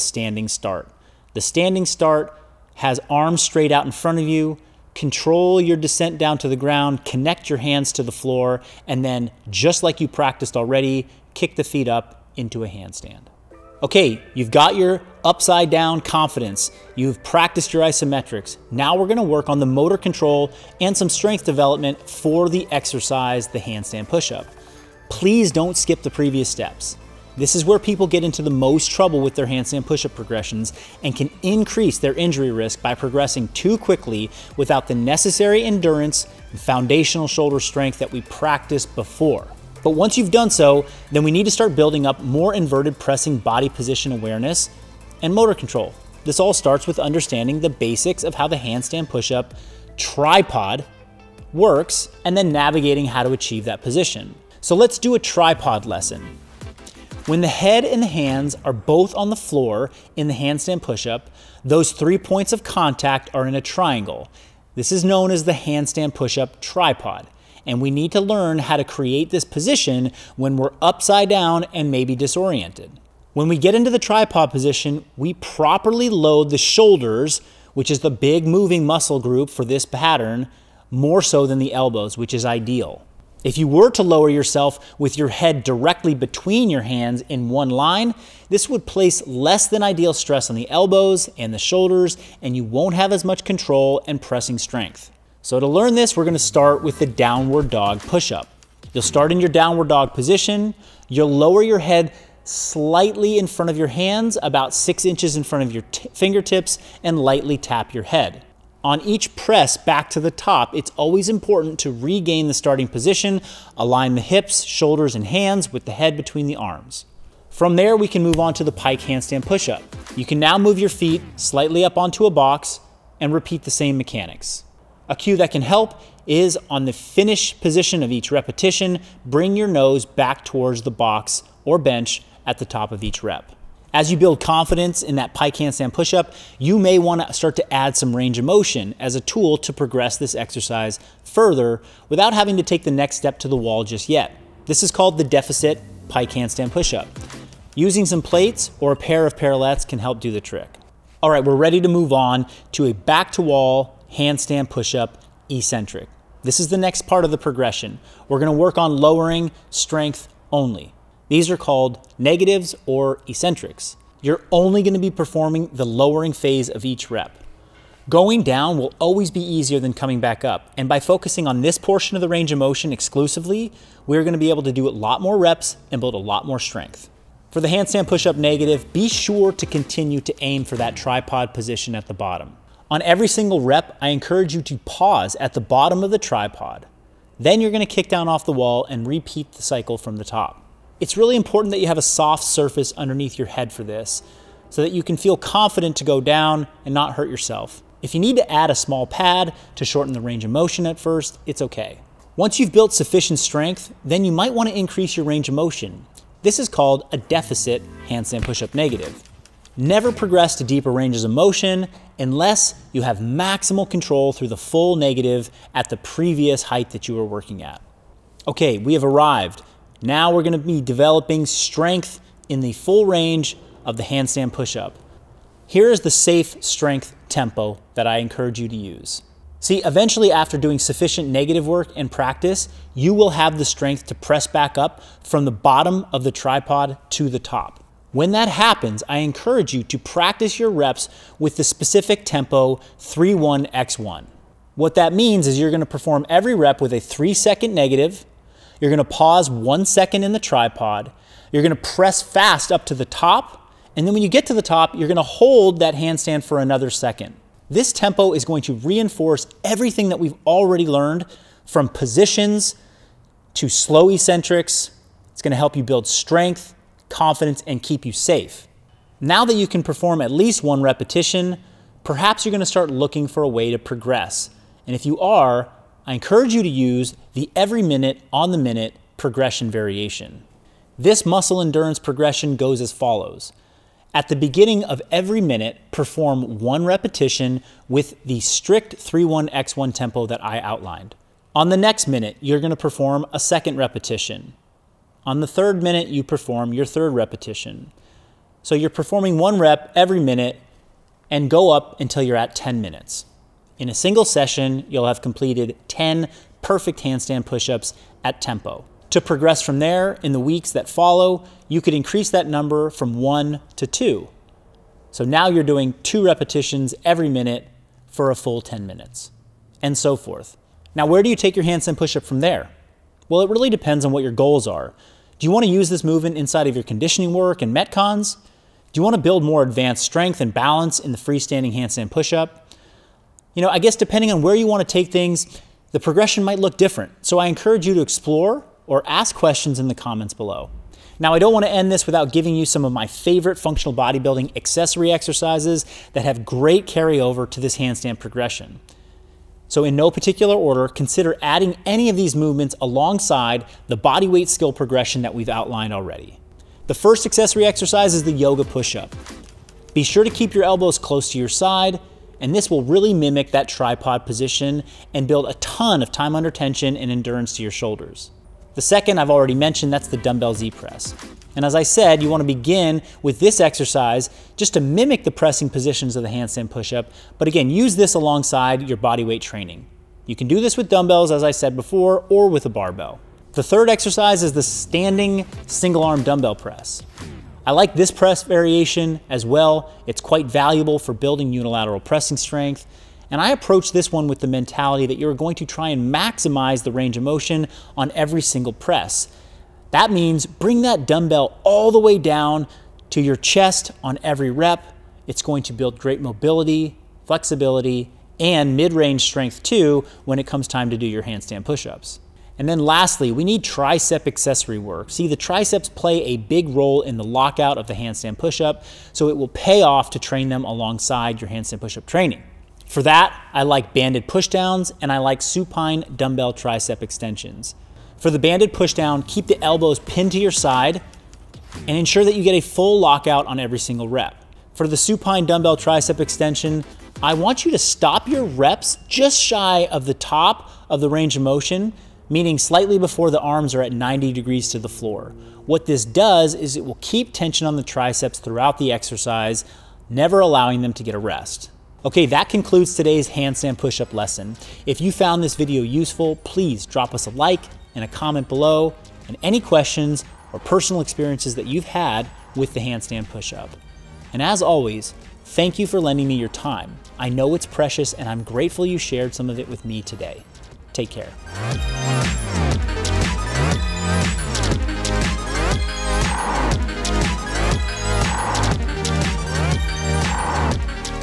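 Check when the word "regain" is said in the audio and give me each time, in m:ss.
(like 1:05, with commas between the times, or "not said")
1:51.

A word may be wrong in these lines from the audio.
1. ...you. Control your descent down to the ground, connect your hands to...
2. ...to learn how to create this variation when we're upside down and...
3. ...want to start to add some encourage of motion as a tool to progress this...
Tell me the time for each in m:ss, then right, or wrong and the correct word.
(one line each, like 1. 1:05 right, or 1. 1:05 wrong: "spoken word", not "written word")
1. 0:04 right
2. 1:08 wrong: "position", not "variation"
3. 2:16 wrong: "range", not "encourage".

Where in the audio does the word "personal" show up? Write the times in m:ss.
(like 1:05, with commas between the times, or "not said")
7:40.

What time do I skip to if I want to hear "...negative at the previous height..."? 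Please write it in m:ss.
3:34.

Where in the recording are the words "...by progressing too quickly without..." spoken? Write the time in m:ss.
0:32.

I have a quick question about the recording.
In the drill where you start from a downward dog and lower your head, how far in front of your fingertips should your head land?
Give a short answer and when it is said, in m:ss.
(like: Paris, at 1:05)
6 inches, at 1:44.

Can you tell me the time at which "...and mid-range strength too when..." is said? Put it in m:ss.
6:48.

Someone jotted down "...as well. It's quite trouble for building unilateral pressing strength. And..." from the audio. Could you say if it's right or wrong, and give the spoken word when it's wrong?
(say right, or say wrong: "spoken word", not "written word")
wrong: "valuable", not "trouble".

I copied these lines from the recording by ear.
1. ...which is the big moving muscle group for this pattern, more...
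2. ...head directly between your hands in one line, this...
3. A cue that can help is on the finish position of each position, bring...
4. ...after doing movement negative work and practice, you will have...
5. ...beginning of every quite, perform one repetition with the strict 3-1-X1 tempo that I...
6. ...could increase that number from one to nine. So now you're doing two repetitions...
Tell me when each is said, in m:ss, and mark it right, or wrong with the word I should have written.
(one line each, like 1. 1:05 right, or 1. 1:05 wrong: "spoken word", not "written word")
1. 1:17 right
2. 1:25 right
3. 2:05 wrong: "repetition", not "position"
4. 3:50 wrong: "sufficient", not "movement"
5. 4:44 wrong: "minute", not "quite"
6. 5:11 wrong: "two", not "nine".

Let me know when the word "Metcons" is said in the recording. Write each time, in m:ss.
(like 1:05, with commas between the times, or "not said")
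5:27.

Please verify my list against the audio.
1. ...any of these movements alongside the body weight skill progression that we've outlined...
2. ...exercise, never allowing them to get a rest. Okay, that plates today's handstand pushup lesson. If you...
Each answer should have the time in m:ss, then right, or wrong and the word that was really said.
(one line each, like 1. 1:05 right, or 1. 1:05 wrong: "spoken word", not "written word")
1. 5:51 right
2. 7:28 wrong: "concludes", not "plates".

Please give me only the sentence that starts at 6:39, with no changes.
That means bring that dumbbell all the way down to your chest on every rep.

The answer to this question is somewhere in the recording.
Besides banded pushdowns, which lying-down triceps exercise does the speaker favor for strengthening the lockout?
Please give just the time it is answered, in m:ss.
7:05.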